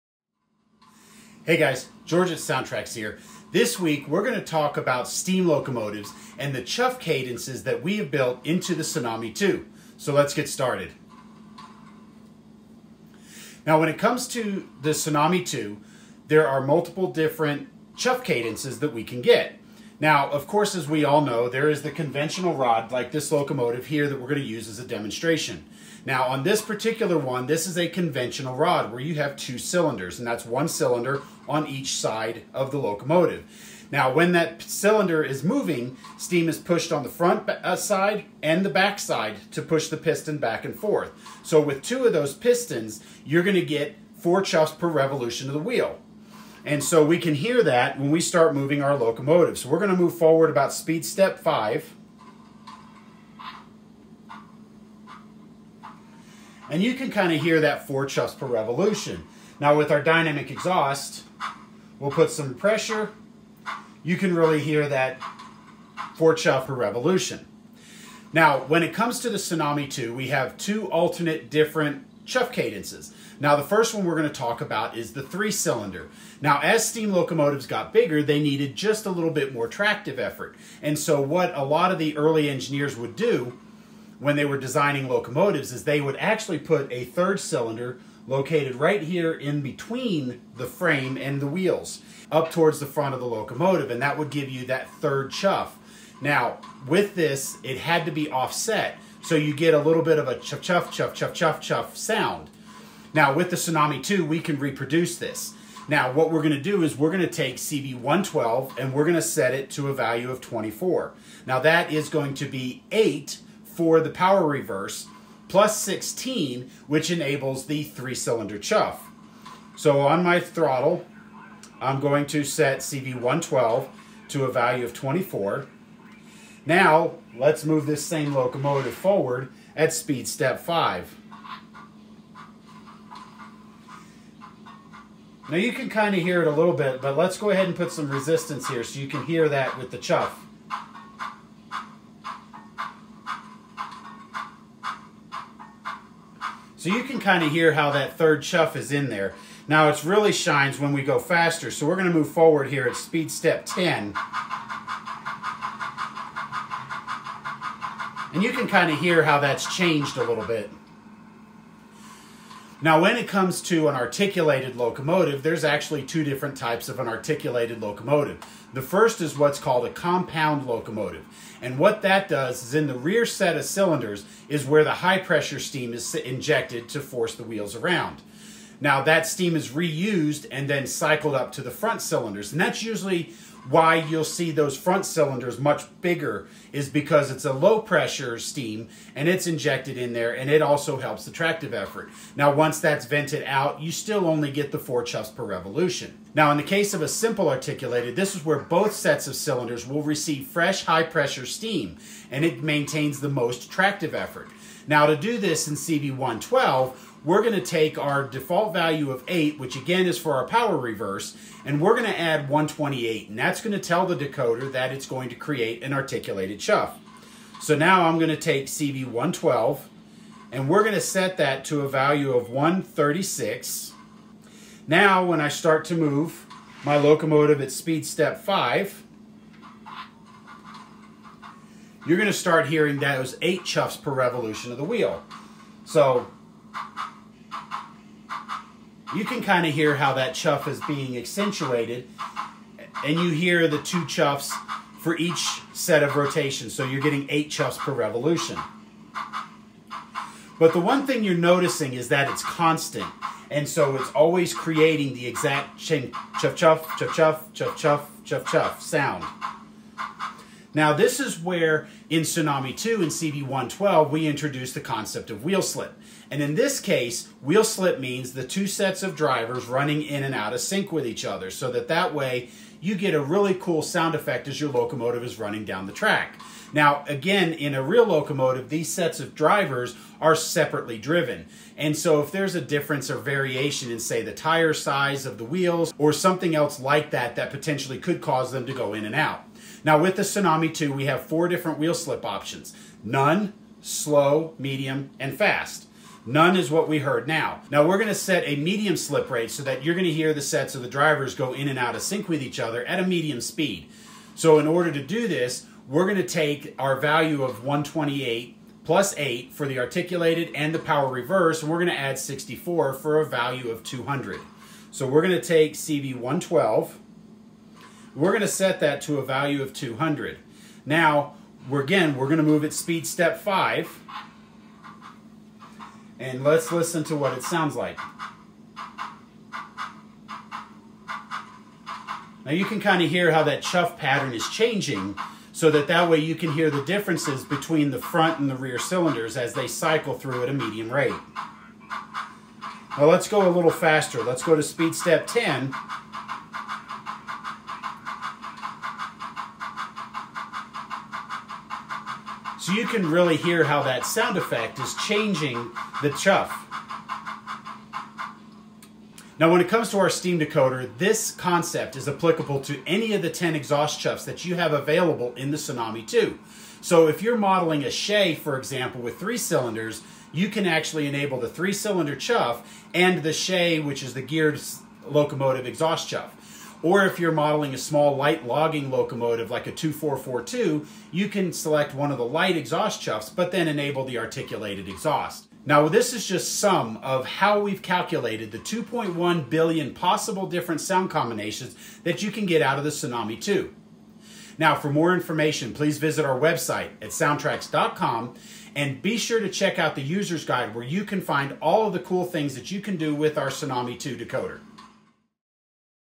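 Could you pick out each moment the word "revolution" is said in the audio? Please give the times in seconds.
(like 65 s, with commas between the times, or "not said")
44 s, 58 s, 66 s, 195 s, 234 s, 247 s.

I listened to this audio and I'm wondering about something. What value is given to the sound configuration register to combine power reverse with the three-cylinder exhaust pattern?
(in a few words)
24.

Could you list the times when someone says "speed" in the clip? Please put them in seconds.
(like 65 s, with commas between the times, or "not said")
50 s, 129 s, 152 s, 227 s, 303 s, 322 s, 344 s.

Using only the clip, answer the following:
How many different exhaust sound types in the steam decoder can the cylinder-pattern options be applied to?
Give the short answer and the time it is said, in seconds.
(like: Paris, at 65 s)
10, at 362 s.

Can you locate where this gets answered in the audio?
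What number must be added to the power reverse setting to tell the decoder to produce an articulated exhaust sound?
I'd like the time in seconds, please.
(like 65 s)
211 s.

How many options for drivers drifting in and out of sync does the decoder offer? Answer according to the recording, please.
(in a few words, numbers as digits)
4.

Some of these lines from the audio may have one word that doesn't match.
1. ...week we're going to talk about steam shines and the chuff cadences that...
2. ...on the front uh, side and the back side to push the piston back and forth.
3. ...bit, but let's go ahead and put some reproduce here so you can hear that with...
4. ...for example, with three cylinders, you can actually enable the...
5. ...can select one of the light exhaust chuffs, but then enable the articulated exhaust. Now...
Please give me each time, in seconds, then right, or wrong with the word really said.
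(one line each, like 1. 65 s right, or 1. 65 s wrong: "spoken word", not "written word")
1. 3 s wrong: "locomotives", not "shines"
2. 36 s right
3. 136 s wrong: "resistance", not "reproduce"
4. 368 s right
5. 381 s right.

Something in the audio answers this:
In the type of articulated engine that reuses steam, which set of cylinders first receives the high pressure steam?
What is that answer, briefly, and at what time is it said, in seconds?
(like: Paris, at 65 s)
rear set, at 172 s.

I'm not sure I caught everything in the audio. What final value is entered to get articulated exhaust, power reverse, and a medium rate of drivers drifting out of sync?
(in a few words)
200.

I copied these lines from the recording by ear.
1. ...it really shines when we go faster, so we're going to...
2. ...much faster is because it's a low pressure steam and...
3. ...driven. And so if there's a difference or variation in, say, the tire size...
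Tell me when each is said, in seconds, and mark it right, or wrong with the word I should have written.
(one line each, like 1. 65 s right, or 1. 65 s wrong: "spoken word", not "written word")
1. 149 s right
2. 185 s wrong: "bigger", not "faster"
3. 280 s right.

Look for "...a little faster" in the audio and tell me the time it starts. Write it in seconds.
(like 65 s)
343 s.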